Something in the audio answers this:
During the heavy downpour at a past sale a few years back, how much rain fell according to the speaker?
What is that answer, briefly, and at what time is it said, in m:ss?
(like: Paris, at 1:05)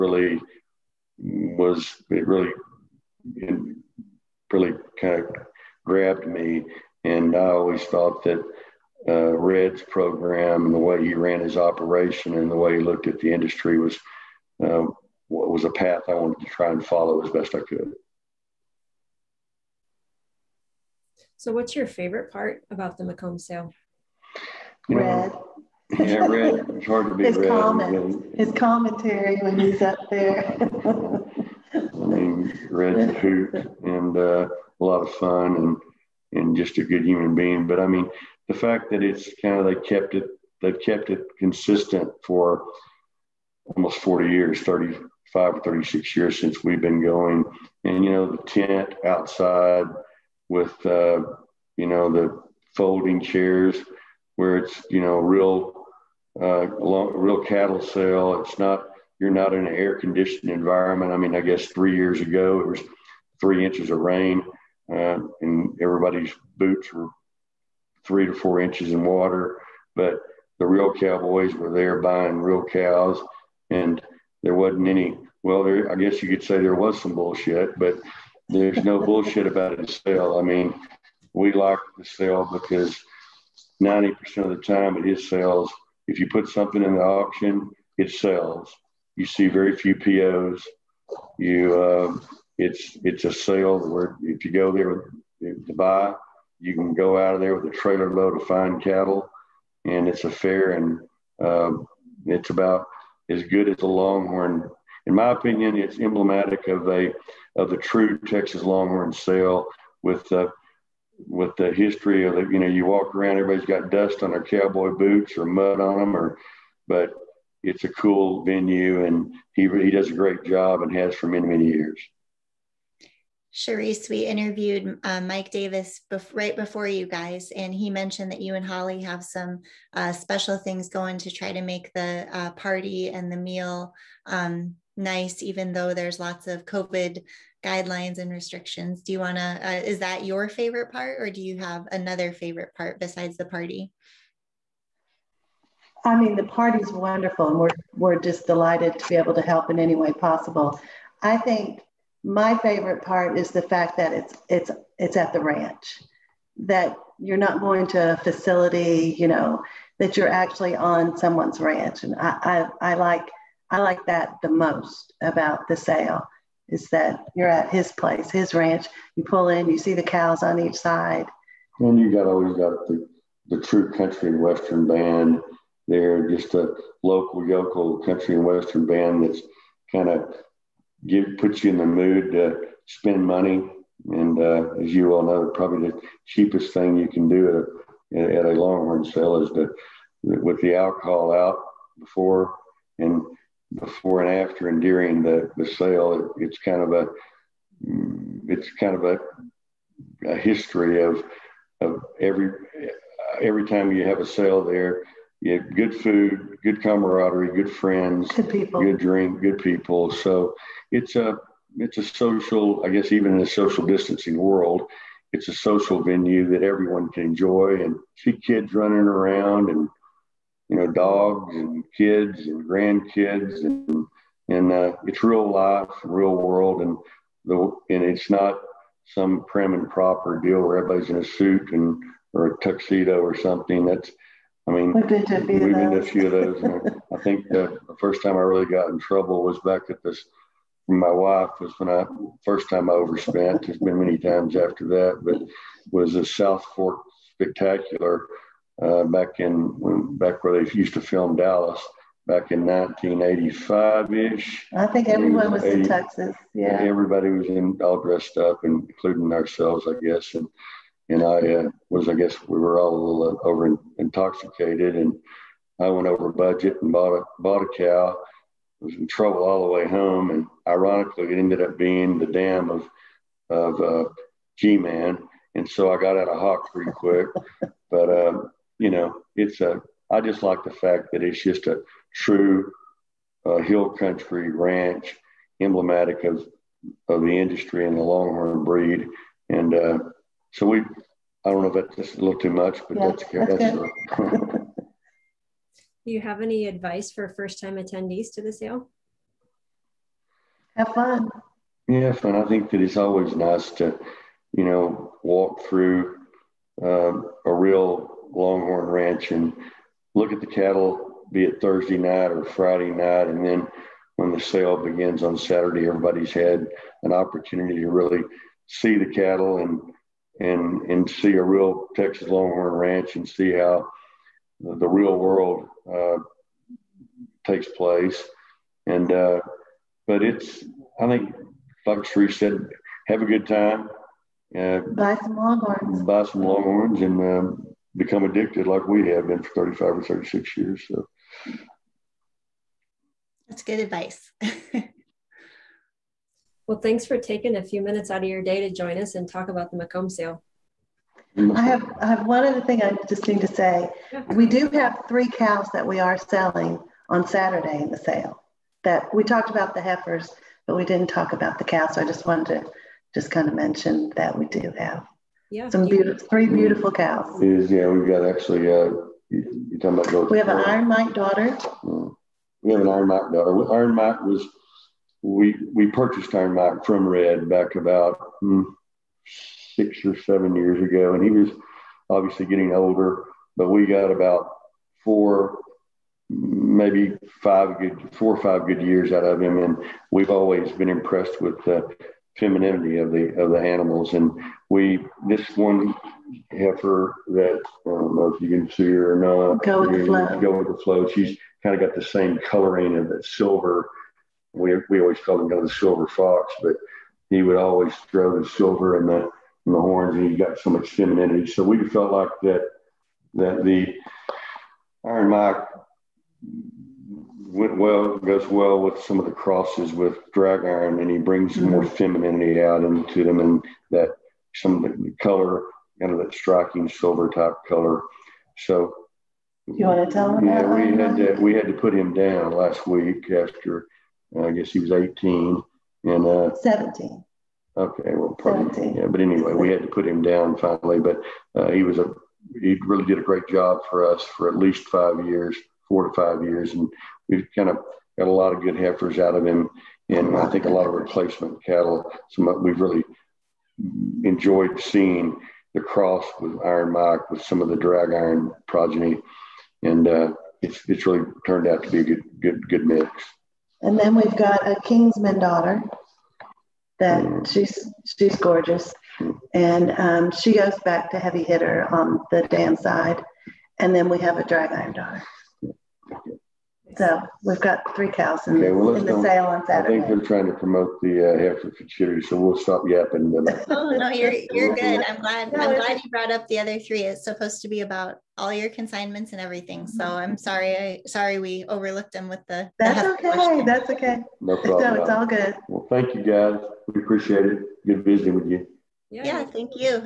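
3 inches, at 1:03.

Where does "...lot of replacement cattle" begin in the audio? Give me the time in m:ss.
7:30.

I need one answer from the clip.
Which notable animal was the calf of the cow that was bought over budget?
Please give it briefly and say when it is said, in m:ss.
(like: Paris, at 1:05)
G-Man, at 4:34.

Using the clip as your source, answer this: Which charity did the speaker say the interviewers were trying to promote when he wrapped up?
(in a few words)
Hanford charity.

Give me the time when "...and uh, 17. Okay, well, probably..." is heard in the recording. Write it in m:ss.
7:16.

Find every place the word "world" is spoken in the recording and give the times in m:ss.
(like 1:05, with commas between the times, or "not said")
3:34, 3:46, 5:25.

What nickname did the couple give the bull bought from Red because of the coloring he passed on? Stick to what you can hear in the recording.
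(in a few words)
the silver fox.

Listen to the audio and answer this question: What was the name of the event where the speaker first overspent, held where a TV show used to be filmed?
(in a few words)
South Fork Spectacular.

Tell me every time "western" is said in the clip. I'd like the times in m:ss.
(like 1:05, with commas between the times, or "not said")
2:54, 2:58.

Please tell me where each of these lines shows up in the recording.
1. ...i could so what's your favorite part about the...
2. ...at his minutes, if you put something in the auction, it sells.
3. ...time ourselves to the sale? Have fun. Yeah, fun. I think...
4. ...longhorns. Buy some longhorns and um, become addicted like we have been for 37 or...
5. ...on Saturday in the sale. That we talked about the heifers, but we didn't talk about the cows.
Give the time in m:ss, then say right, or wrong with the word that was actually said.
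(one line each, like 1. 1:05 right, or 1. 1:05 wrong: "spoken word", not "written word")
1. 0:17 right
2. 1:24 wrong: "sales", not "minutes"
3. 4:57 wrong: "attendees", not "ourselves"
4. 5:35 wrong: "35", not "37"
5. 5:57 right.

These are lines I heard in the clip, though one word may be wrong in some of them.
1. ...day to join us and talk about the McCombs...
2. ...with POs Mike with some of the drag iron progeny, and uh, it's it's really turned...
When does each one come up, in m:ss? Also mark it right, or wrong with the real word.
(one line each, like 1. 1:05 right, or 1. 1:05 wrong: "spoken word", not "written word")
1. 5:48 right
2. 7:36 wrong: "Iron", not "POs".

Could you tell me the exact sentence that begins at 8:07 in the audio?
It's supposed to be about all your consignments and everything.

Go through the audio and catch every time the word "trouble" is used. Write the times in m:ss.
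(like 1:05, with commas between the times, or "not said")
3:58, 4:29.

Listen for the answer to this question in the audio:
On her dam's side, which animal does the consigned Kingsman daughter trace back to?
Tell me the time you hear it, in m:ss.
7:51.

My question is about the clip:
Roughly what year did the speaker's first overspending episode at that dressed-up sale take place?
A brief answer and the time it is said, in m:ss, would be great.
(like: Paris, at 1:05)
1985, at 4:12.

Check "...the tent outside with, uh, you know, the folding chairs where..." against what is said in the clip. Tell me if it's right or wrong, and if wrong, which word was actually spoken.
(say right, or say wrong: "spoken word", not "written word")
right.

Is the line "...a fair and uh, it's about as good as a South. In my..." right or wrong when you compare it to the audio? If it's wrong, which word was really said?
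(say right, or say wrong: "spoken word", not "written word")
wrong: "Longhorn", not "South".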